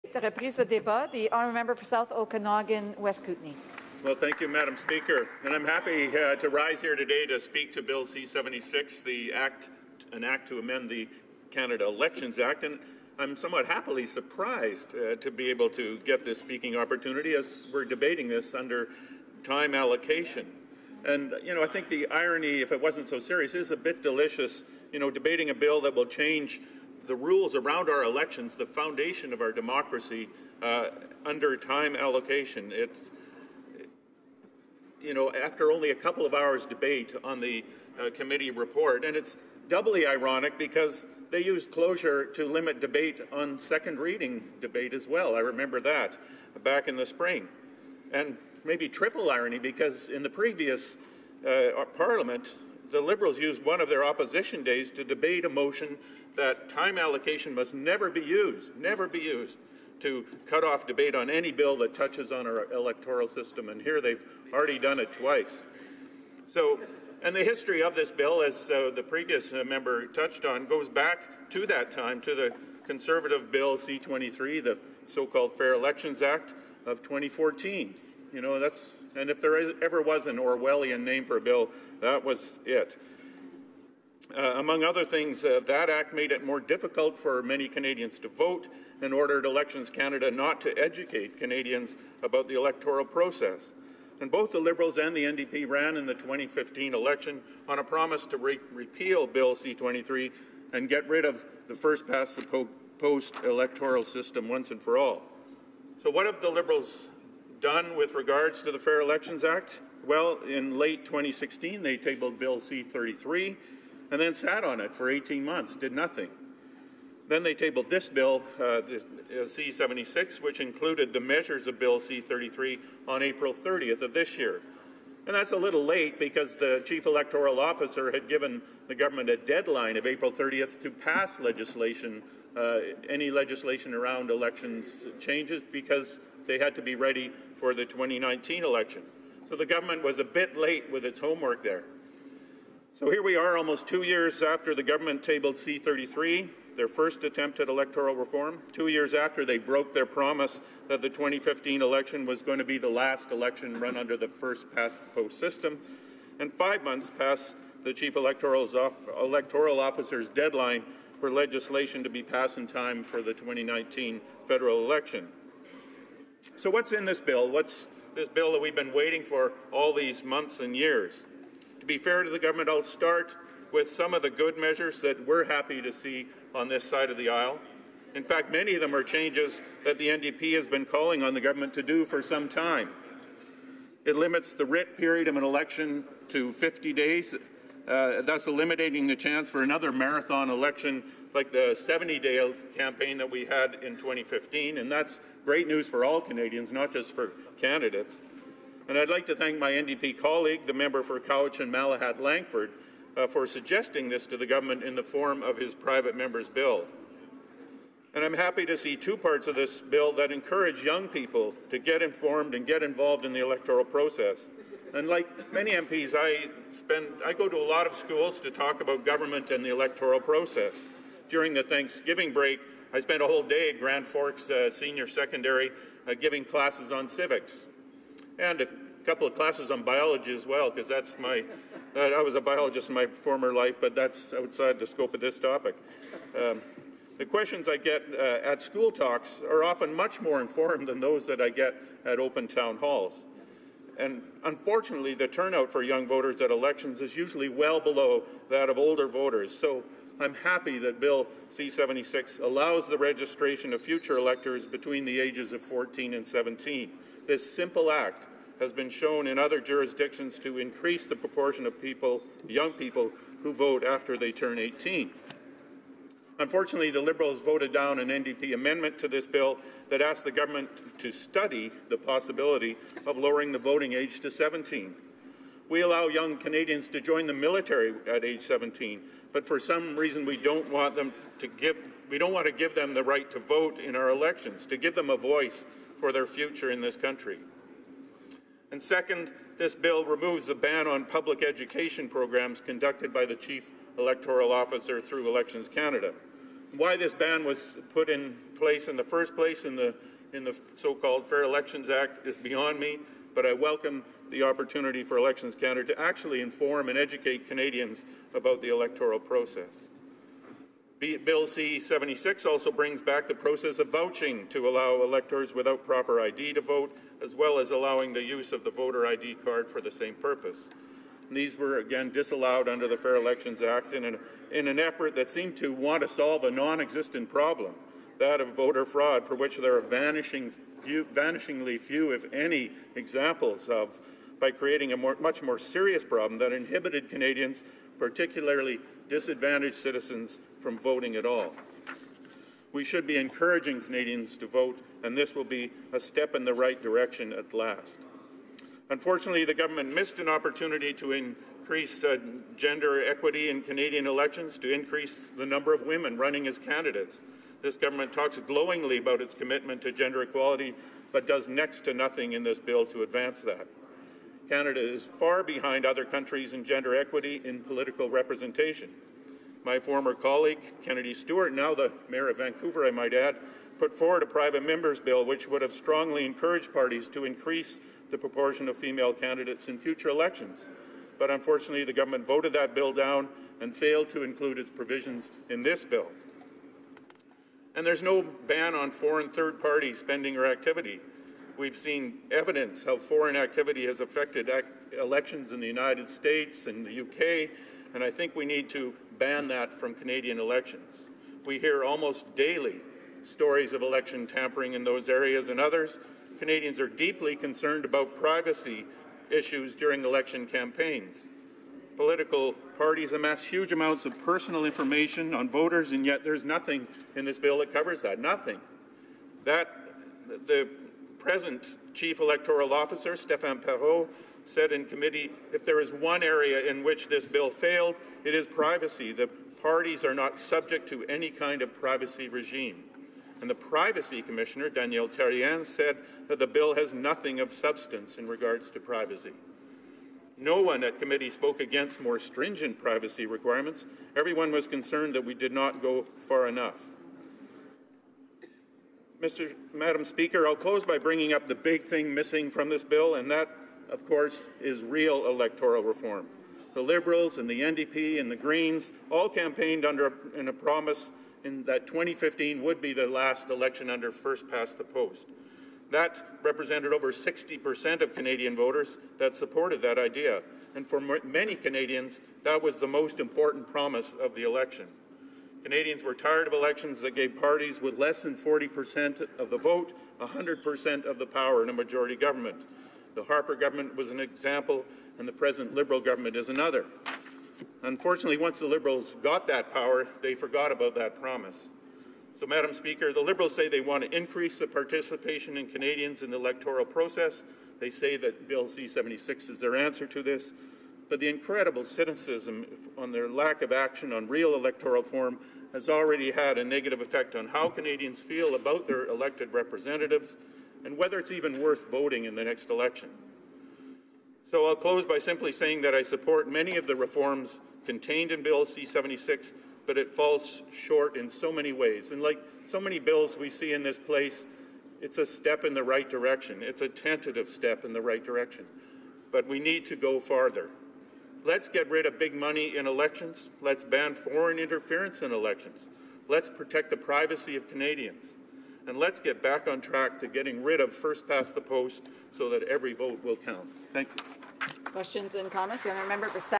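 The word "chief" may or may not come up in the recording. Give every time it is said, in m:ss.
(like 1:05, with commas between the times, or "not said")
2:06, 2:37, 4:53, 7:01.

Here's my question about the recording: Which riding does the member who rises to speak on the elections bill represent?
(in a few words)
South Okanagan, West Kootenay.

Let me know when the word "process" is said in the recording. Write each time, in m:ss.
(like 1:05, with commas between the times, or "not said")
1:33, 3:33, 3:40, 5:09, 5:13, 8:16.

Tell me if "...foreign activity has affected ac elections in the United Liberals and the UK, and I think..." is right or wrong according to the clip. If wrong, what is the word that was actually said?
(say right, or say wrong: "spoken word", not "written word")
wrong: "States", not "Liberals".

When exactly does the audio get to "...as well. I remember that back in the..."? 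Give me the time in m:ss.
0:44.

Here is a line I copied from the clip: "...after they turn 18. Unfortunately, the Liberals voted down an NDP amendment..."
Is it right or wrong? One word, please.
right.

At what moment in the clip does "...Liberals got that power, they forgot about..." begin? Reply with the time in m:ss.
8:08.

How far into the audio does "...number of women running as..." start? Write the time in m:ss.
5:55.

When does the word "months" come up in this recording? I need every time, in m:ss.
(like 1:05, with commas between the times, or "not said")
1:55, 2:36, 2:50.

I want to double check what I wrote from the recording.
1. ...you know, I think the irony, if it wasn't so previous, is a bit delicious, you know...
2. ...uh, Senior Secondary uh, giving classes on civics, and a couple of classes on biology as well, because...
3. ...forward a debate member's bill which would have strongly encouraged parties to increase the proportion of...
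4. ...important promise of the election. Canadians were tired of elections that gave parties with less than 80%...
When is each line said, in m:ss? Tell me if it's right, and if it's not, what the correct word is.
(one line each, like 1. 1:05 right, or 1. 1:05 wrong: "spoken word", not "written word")
1. 0:21 wrong: "serious", not "previous"
2. 3:44 right
3. 6:13 wrong: "private", not "debate"
4. 7:53 wrong: "40", not "80".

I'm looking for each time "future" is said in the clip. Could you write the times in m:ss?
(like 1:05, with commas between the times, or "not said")
4:13, 4:46, 6:19.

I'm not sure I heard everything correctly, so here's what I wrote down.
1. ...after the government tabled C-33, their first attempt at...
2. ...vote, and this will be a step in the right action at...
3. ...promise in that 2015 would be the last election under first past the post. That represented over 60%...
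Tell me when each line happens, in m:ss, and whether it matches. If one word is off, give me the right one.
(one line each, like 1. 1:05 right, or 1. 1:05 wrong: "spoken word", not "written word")
1. 2:24 right
2. 5:44 wrong: "direction", not "action"
3. 7:40 right.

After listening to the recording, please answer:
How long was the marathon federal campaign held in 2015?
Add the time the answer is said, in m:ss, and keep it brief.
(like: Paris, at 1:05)
70 days, at 3:11.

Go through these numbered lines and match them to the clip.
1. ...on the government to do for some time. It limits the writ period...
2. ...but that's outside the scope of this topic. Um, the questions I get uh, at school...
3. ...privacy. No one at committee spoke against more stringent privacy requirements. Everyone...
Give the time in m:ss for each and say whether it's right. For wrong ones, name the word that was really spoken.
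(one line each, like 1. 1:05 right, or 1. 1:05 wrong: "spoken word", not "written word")
1. 3:01 right
2. 3:53 right
3. 7:18 right.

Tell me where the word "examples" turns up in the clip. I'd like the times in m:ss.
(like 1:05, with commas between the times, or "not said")
5:32, 8:04.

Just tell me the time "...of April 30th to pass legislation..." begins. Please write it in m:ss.
2:09.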